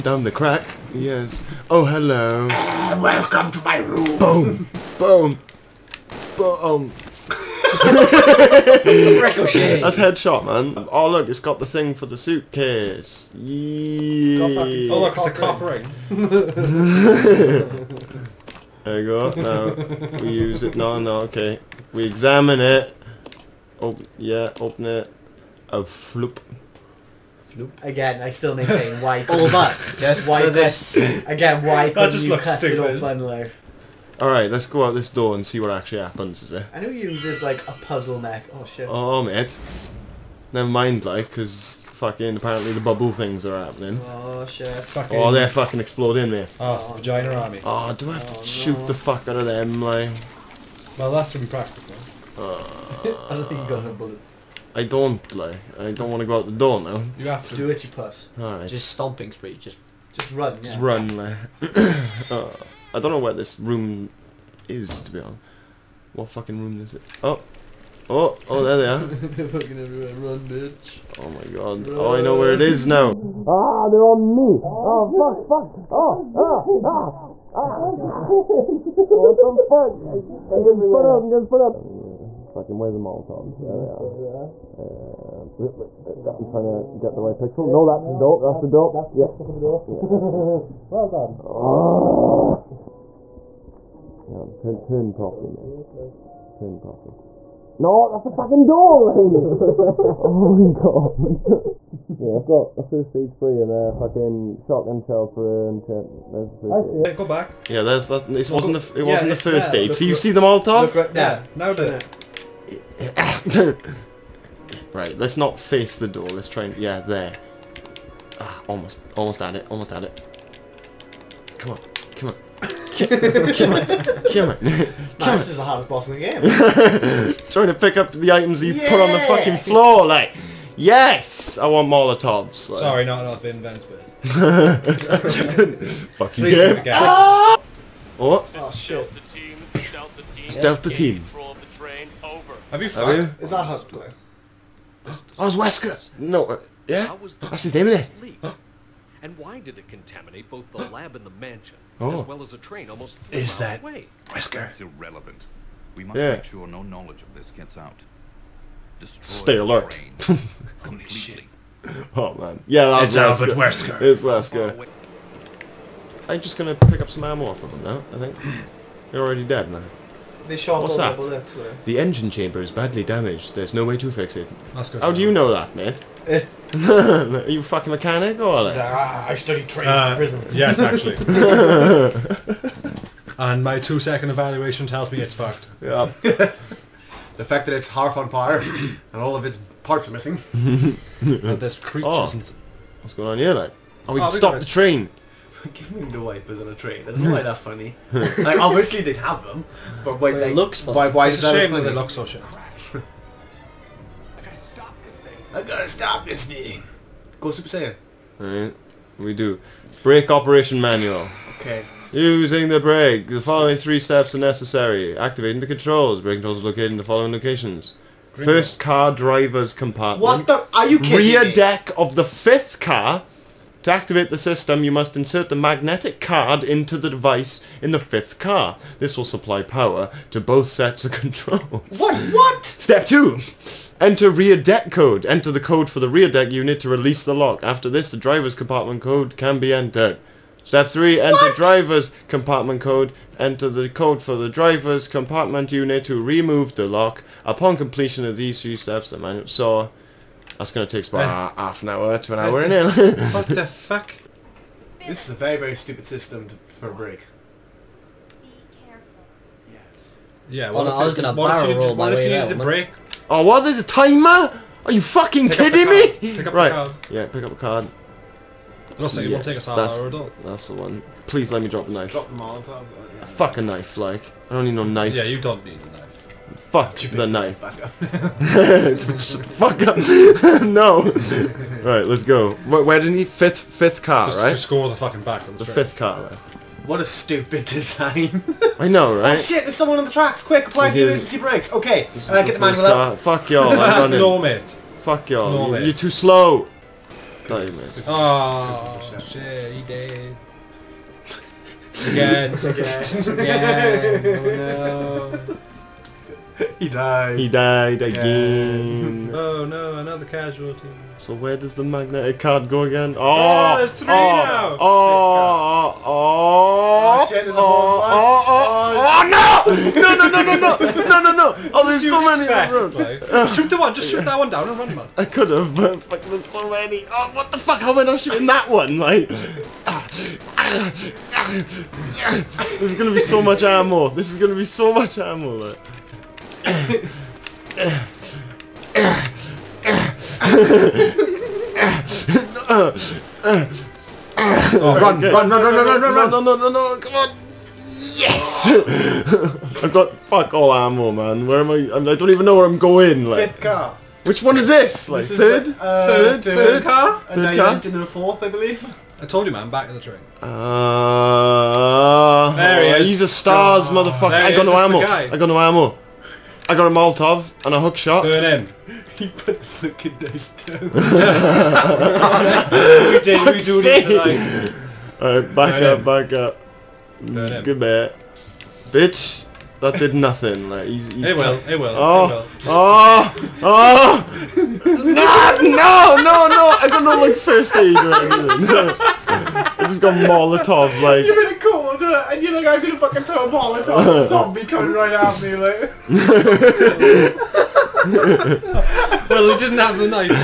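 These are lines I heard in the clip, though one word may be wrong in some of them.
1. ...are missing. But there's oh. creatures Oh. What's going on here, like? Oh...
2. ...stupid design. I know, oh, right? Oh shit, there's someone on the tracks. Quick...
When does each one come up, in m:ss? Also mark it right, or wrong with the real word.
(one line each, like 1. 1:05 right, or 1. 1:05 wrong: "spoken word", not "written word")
1. 3:10 right
2. 4:47 right.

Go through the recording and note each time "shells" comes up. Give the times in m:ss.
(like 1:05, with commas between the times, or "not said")
1:44.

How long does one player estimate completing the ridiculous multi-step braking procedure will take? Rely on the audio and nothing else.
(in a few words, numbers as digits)
half an hour to an hour.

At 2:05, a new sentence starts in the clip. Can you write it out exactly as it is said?
This is the hardest boss in the game.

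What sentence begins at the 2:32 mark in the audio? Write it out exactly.
as well as a train almost three is miles that Wesker?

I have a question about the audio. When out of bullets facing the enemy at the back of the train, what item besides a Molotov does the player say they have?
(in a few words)
a hook shot.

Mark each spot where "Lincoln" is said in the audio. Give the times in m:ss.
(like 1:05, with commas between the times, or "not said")
not said.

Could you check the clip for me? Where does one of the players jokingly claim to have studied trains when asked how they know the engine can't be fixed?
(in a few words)
prison.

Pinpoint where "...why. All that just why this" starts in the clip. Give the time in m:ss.
0:29.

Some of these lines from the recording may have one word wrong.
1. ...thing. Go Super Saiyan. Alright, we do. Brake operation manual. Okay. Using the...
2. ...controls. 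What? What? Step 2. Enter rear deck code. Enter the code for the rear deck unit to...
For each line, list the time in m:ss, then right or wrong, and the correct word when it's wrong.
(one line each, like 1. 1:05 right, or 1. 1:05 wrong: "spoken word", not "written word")
1. 3:26 right
2. 3:51 right.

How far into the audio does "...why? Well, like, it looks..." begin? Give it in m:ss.
3:20.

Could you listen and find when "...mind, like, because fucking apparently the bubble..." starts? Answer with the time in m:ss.
0:40.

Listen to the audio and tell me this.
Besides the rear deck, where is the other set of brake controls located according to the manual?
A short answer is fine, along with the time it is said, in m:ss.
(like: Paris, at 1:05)
first car driver's compartment, at 3:38.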